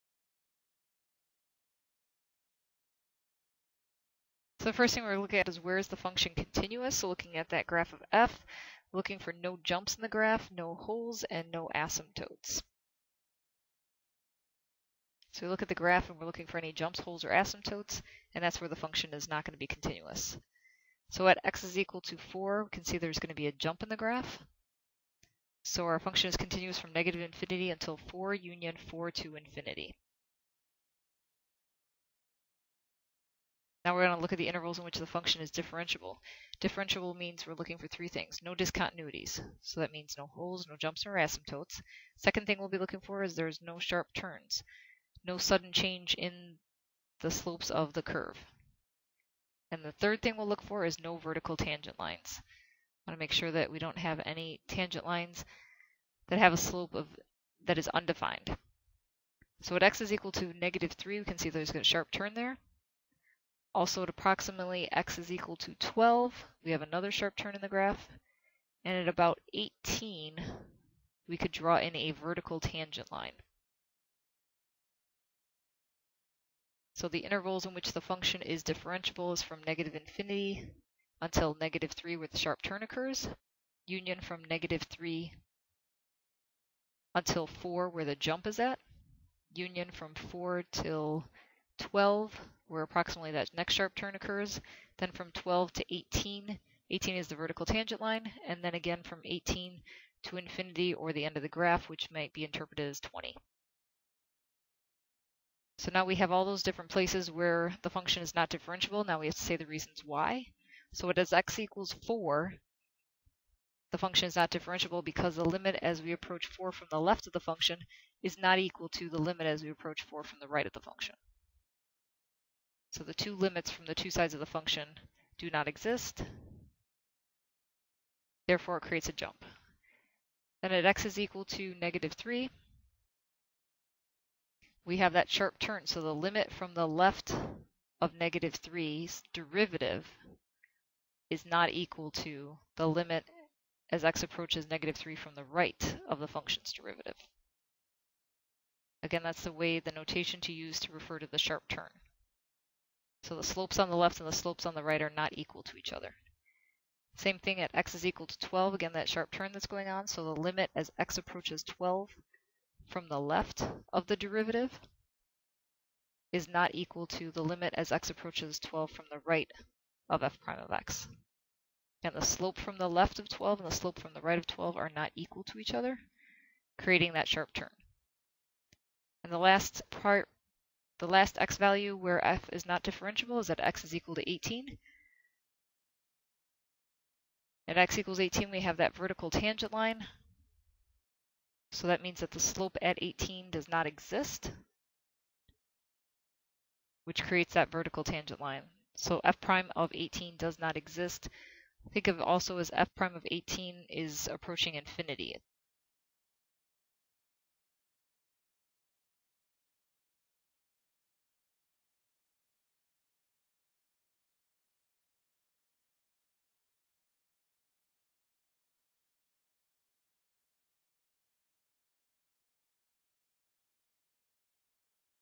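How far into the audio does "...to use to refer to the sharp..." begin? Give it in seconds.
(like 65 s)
150 s.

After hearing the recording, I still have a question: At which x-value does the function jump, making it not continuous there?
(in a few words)
4.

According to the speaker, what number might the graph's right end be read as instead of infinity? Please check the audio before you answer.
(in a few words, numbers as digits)
20.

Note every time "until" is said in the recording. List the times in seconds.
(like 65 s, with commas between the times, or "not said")
27 s, 81 s, 87 s.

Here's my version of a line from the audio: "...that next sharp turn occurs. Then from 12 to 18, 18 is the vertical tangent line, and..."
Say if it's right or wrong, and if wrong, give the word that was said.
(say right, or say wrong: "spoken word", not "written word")
right.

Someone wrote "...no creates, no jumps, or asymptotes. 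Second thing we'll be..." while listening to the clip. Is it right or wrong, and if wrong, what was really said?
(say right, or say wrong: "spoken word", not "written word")
wrong: "holes", not "creates".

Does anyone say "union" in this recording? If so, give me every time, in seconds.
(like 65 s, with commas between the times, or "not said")
28 s, 83 s, 89 s.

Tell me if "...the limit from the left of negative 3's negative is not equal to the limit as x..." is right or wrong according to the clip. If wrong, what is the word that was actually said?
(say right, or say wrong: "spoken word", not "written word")
wrong: "derivative", not "negative".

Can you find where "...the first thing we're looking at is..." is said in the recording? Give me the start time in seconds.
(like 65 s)
4 s.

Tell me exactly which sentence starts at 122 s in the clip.
So the two limits from the two sides of the function do not exist.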